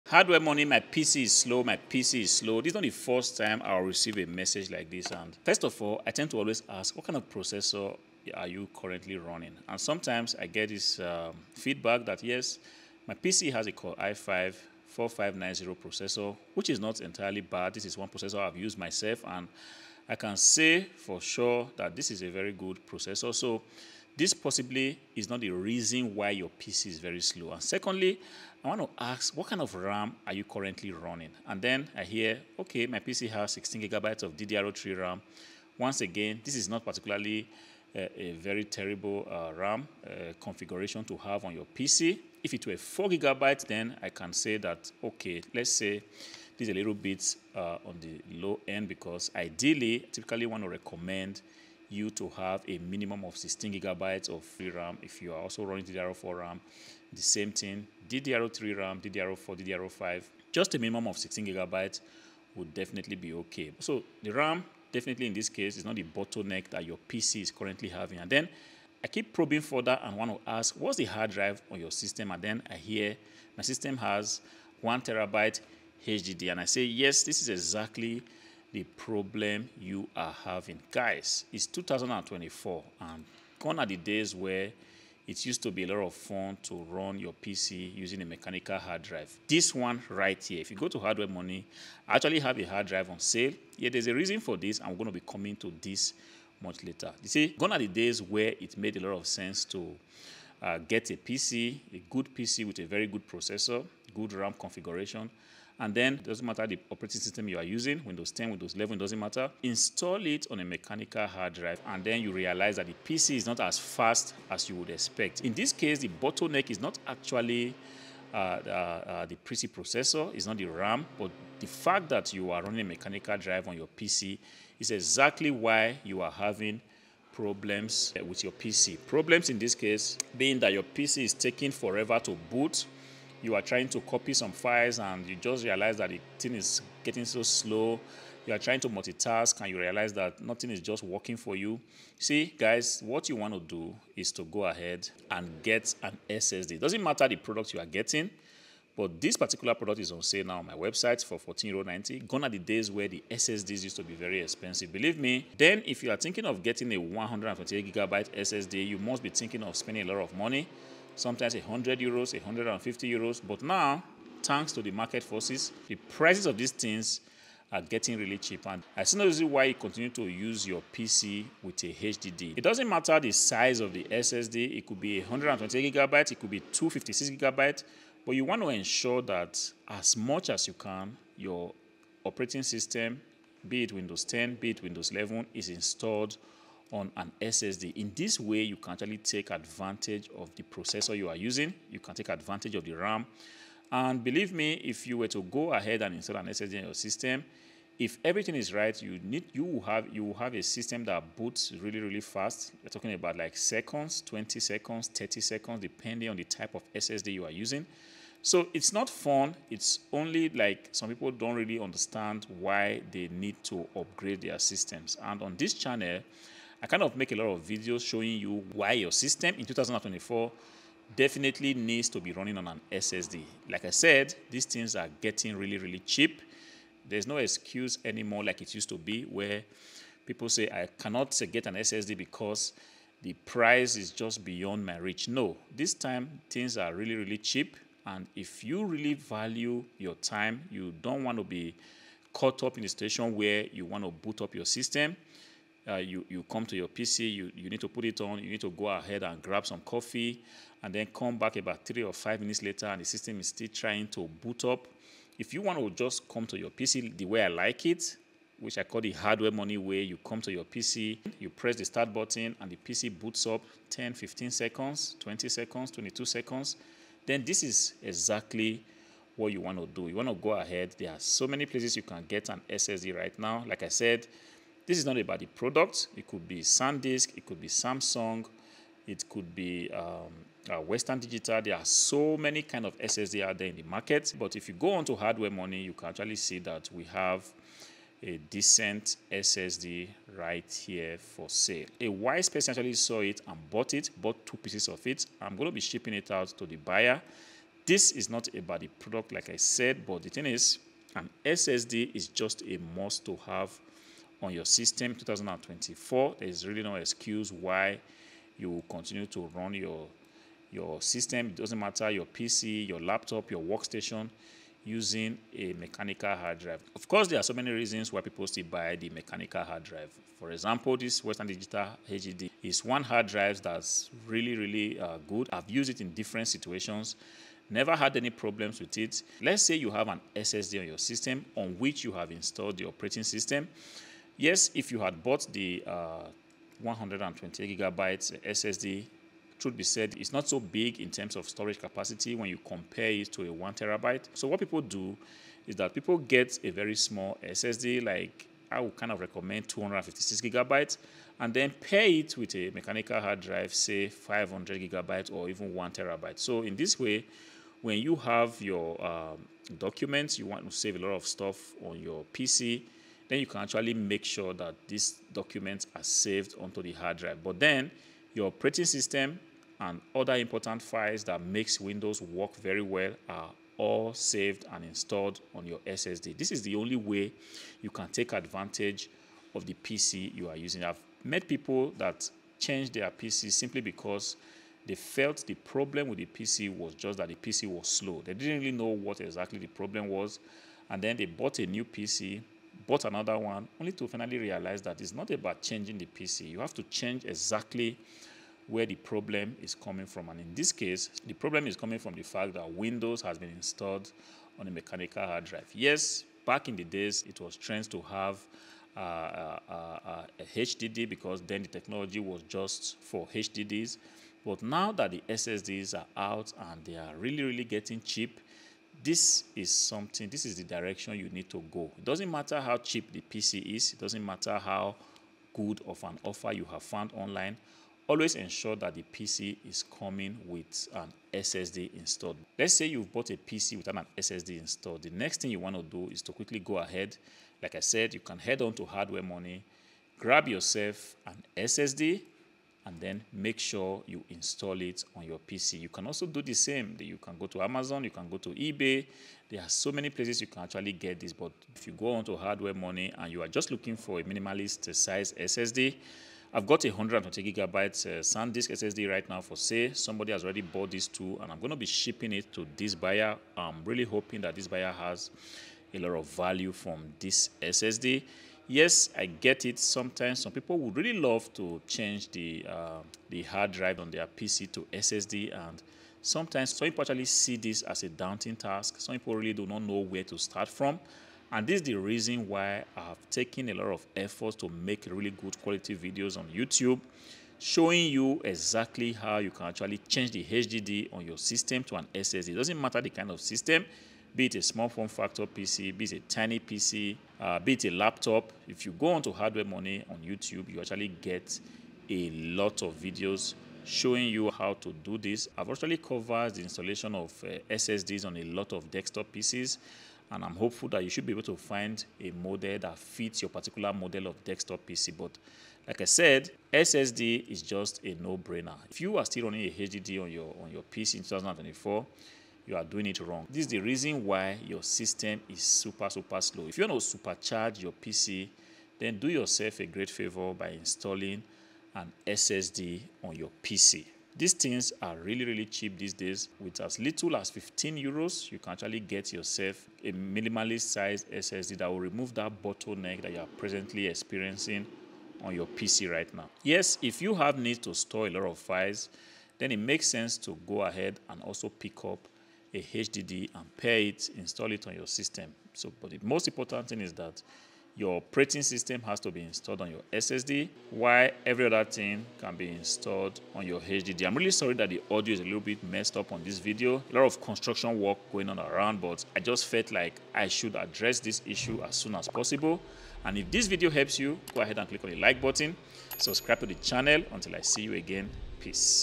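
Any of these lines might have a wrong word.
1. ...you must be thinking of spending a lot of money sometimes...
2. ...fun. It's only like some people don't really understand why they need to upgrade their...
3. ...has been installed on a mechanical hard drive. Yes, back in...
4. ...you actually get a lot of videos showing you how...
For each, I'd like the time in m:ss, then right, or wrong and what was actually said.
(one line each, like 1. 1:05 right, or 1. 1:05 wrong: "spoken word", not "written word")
1. 2:38 right
2. 3:29 right
3. 6:43 right
4. 8:20 right.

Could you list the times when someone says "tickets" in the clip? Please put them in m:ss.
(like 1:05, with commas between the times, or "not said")
not said.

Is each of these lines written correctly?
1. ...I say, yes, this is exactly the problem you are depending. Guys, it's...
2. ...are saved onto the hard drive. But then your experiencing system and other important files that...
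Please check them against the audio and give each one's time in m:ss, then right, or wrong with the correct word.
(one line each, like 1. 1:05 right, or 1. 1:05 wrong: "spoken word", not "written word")
1. 1:16 wrong: "having", not "depending"
2. 6:05 wrong: "operating", not "experiencing".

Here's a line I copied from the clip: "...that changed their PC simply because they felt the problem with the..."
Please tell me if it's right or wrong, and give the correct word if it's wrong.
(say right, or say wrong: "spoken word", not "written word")
right.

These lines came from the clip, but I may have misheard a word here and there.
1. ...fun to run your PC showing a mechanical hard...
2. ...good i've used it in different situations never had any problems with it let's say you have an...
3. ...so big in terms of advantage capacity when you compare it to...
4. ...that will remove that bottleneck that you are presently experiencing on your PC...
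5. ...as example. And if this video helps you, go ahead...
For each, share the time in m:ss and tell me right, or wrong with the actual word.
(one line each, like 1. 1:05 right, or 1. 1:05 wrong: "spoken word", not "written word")
1. 1:26 wrong: "using", not "showing"
2. 5:25 right
3. 5:40 wrong: "storage", not "advantage"
4. 9:01 right
5. 9:32 wrong: "possible", not "example".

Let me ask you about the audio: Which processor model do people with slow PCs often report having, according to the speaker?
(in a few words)
Core i5 4590.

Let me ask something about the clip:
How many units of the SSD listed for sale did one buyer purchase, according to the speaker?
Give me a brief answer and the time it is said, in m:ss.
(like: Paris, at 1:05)
2, at 4:54.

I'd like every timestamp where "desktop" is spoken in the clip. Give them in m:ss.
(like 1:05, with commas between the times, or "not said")
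8:28, 8:34.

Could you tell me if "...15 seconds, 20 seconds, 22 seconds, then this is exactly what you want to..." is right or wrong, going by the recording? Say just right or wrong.
right.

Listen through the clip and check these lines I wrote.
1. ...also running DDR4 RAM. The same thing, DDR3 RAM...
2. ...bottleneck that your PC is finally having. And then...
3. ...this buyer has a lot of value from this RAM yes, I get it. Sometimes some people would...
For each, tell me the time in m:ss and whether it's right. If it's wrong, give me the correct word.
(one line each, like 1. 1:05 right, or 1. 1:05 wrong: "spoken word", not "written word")
1. 0:55 right
2. 1:06 wrong: "currently", not "finally"
3. 7:44 wrong: "SSD", not "RAM".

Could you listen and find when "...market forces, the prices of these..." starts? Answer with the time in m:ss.
2:44.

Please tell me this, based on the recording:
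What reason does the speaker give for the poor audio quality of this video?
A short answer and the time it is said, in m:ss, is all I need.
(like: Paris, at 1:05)
construction work, at 9:27.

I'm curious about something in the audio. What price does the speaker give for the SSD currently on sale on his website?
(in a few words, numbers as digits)
14.90 euros.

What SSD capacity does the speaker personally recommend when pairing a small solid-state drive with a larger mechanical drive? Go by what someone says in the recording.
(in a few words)
256 GB.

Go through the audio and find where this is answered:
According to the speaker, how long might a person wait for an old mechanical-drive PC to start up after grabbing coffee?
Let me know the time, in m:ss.
4:11.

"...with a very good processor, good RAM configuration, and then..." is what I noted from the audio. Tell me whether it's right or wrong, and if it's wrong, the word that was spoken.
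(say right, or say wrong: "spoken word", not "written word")
right.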